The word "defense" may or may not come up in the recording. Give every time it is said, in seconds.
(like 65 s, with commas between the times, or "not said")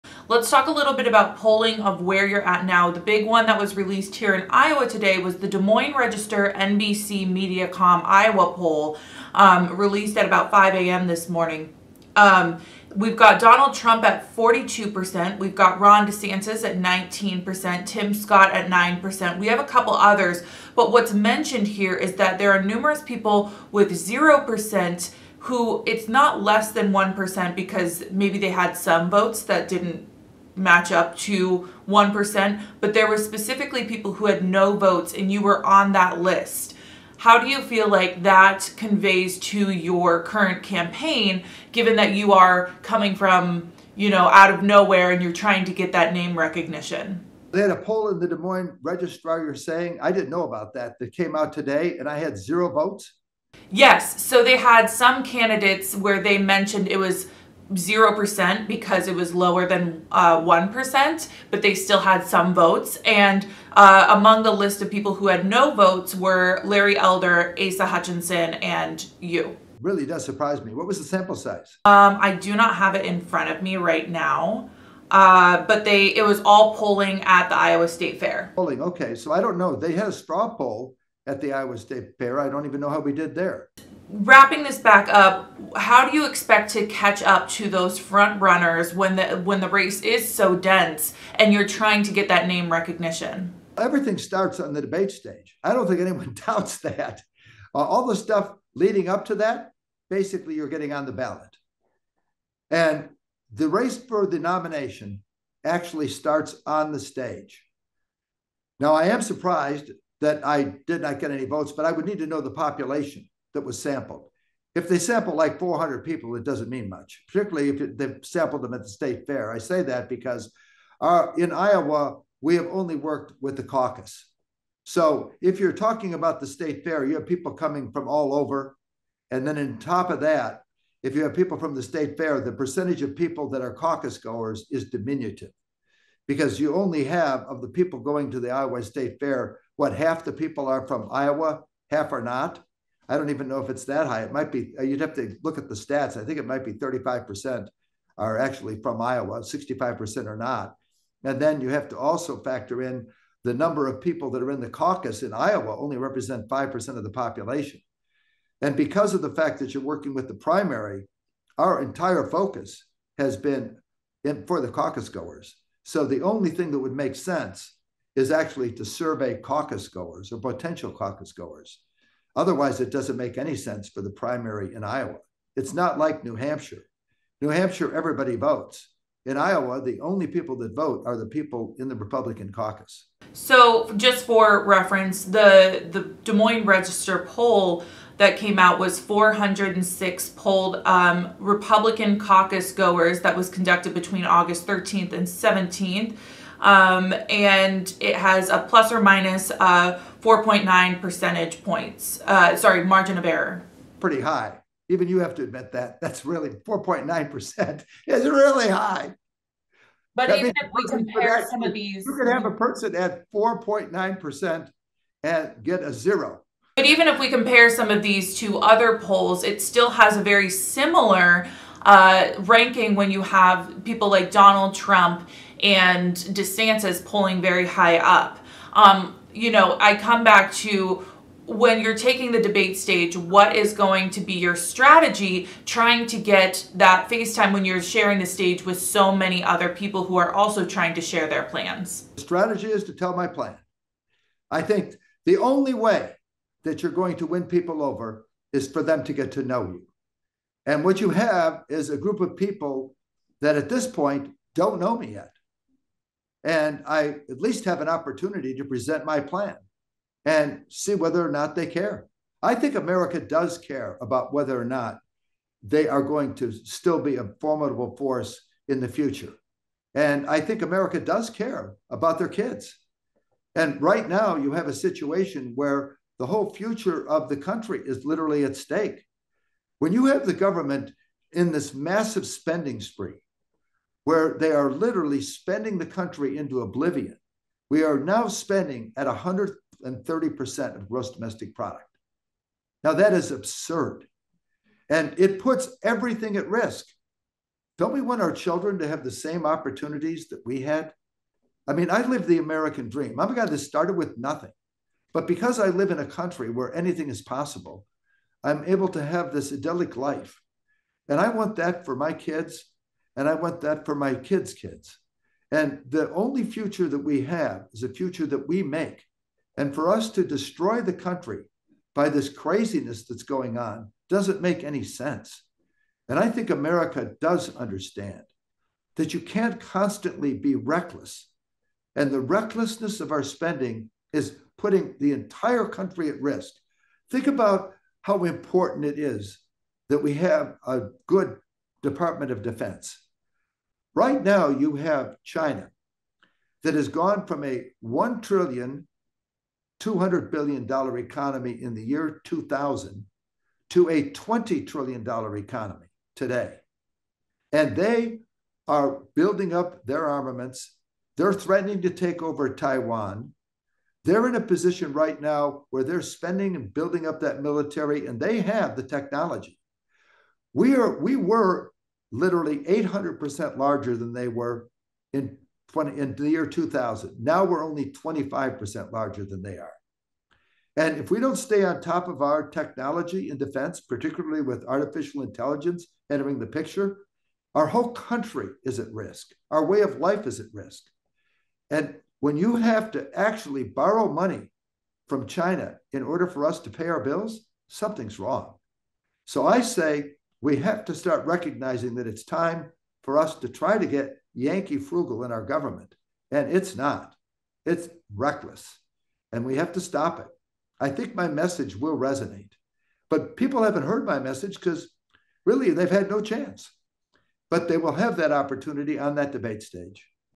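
342 s, 383 s.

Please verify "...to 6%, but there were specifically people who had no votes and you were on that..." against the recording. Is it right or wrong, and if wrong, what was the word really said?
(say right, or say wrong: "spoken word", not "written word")
wrong: "1", not "6".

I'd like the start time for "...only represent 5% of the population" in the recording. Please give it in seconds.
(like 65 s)
155 s.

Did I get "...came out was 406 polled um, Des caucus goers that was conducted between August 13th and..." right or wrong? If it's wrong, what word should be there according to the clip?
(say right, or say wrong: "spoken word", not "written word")
wrong: "Republican", not "Des".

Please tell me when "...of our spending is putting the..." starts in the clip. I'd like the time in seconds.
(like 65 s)
333 s.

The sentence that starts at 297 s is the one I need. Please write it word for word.
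Don't we want our children to have the same opportunities that we had?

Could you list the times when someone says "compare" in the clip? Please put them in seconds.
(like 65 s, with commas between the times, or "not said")
210 s, 217 s.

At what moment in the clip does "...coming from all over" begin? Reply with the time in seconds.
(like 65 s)
127 s.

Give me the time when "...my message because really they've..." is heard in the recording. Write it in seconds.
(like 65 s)
414 s.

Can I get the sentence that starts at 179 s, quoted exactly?
In Iowa, the only people that vote are the people in the Republican caucus.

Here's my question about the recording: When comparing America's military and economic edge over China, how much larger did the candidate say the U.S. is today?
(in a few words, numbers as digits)
25%.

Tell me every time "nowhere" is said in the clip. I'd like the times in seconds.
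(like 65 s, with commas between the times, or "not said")
44 s.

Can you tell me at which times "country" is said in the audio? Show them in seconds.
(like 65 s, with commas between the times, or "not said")
277 s, 285 s, 306 s, 320 s, 335 s, 387 s.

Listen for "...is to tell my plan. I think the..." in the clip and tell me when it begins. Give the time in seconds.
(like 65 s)
242 s.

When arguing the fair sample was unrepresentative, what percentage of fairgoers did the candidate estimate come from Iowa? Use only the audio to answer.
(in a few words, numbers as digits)
35%.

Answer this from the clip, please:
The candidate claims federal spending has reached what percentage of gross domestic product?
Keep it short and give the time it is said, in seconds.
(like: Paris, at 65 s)
130%, at 289 s.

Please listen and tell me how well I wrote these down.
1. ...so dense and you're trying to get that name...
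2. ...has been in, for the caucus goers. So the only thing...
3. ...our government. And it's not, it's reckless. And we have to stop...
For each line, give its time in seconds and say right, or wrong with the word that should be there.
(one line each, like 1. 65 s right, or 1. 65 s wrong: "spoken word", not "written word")
1. 90 s right
2. 163 s right
3. 405 s right.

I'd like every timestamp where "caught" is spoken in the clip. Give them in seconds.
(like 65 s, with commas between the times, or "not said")
not said.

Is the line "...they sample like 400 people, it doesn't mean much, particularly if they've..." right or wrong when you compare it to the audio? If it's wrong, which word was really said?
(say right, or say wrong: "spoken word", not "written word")
right.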